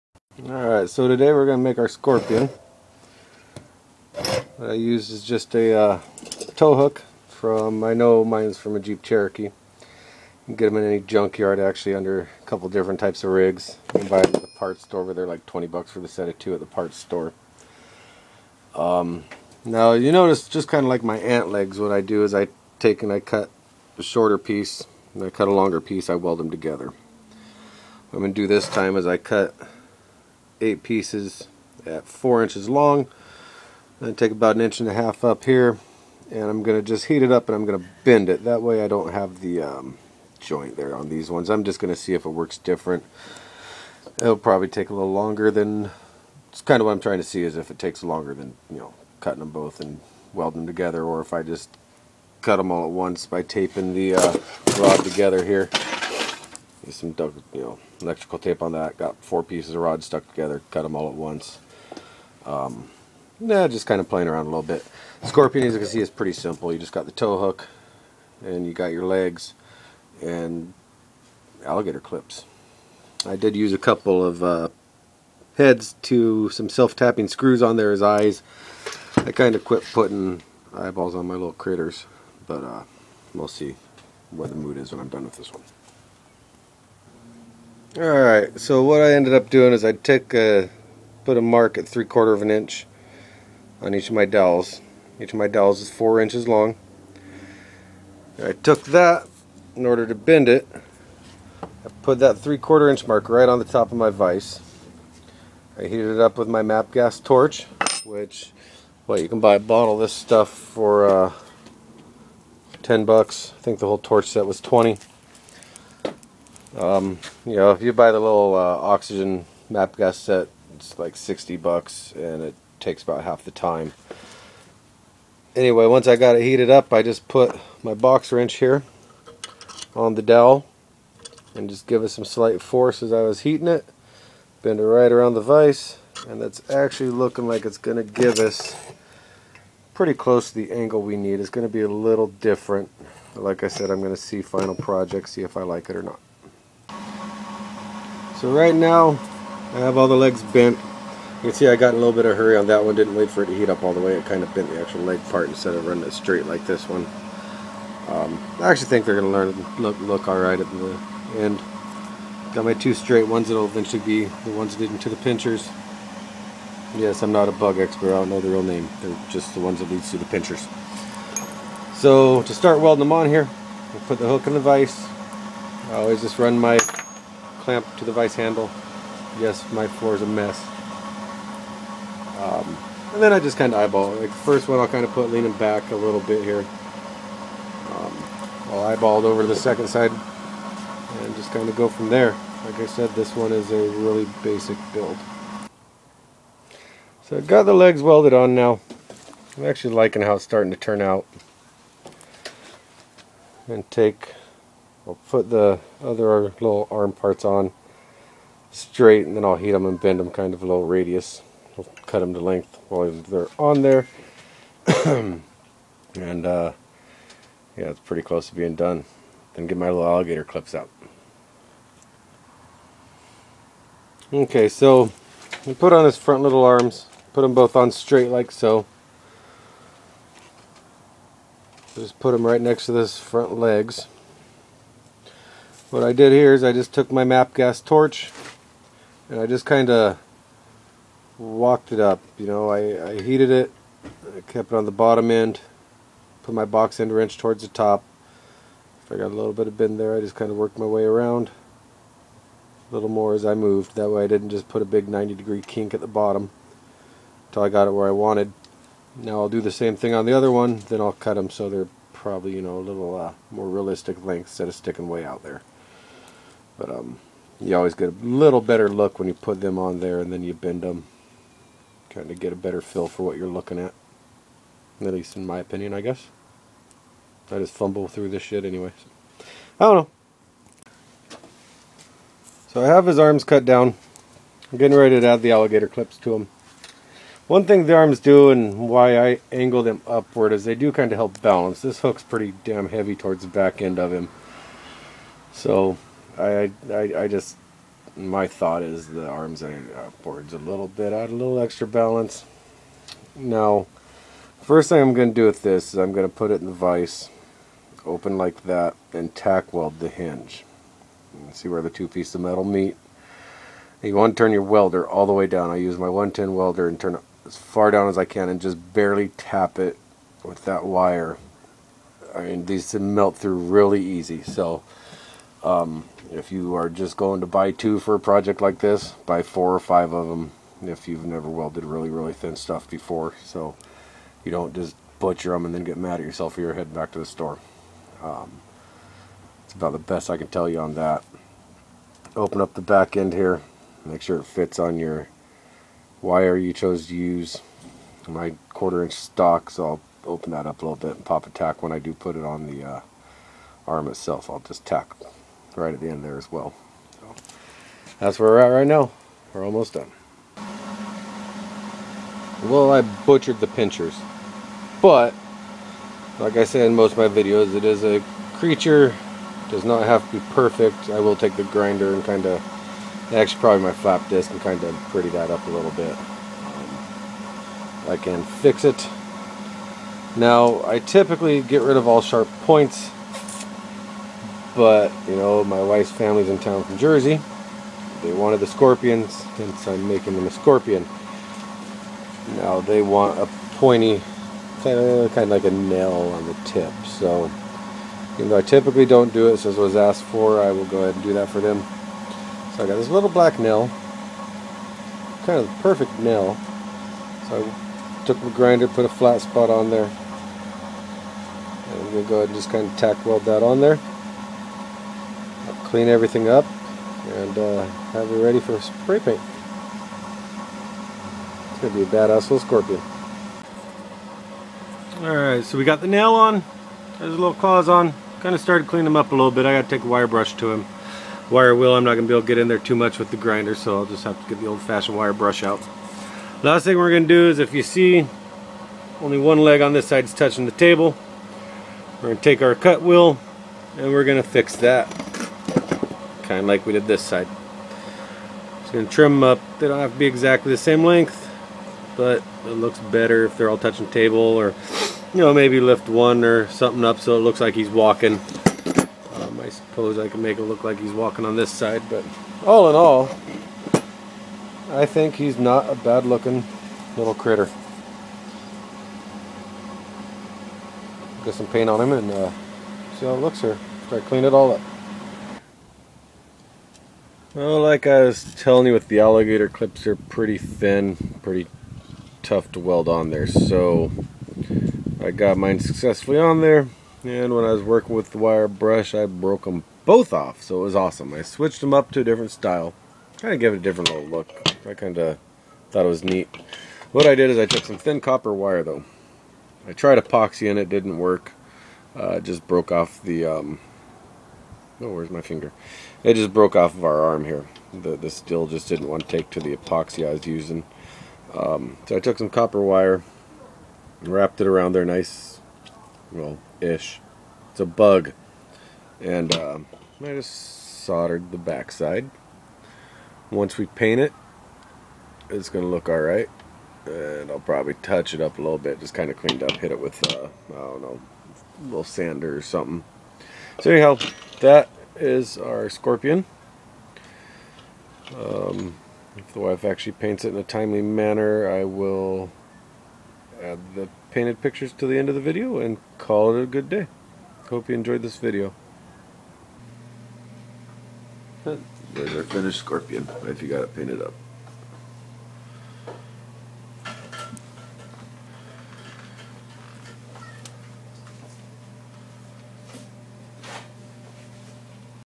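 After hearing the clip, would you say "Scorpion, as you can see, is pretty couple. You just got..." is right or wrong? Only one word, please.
wrong.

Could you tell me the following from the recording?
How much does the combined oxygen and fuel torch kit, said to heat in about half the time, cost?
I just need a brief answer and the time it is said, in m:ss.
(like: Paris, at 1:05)
$60, at 2:01.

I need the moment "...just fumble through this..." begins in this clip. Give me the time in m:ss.
4:37.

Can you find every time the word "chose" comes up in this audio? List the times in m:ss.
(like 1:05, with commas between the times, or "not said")
5:46.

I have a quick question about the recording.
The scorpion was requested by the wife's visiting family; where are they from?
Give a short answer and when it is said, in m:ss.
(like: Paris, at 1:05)
Jersey, at 6:26.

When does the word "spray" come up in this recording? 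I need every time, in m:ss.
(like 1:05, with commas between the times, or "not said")
6:58.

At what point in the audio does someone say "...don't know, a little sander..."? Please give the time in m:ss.
8:50.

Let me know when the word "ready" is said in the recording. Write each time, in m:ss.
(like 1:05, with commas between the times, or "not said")
4:44, 6:58.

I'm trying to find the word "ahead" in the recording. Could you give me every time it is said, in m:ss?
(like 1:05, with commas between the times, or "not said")
6:41, 6:52.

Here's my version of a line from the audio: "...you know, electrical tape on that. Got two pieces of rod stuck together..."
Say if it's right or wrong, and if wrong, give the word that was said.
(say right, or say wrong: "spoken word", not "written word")
wrong: "four", not "two".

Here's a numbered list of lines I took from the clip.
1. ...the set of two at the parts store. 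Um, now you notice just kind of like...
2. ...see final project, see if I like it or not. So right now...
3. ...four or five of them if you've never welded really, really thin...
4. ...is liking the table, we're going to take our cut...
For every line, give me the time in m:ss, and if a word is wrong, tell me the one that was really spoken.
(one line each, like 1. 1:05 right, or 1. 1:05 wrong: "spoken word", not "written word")
1. 0:15 right
2. 2:24 right
3. 5:29 right
4. 7:20 wrong: "touching", not "liking".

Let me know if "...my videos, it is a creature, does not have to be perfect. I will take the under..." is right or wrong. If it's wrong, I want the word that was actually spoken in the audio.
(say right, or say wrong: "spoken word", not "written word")
wrong: "grinder", not "under".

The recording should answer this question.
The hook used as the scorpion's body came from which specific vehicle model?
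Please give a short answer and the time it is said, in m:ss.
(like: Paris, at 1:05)
Jeep Cherokee, at 0:08.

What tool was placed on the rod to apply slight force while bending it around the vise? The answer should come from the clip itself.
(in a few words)
box wrench.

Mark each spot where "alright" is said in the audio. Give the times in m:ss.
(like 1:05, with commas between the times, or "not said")
0:00, 1:27, 2:40, 7:05, 8:46.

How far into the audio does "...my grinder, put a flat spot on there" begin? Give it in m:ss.
6:48.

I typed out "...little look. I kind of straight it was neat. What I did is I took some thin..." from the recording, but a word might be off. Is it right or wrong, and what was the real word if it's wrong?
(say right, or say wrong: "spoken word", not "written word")
wrong: "thought", not "straight".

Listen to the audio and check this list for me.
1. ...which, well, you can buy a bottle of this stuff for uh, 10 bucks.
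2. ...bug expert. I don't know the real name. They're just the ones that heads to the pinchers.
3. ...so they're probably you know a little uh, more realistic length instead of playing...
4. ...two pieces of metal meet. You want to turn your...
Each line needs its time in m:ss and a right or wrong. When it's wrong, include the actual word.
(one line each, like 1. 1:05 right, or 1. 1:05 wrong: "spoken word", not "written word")
1. 1:48 right
2. 2:47 wrong: "leads", not "heads"
3. 4:21 wrong: "sticking", not "playing"
4. 5:11 right.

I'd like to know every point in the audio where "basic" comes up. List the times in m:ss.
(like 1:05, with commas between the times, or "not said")
3:14.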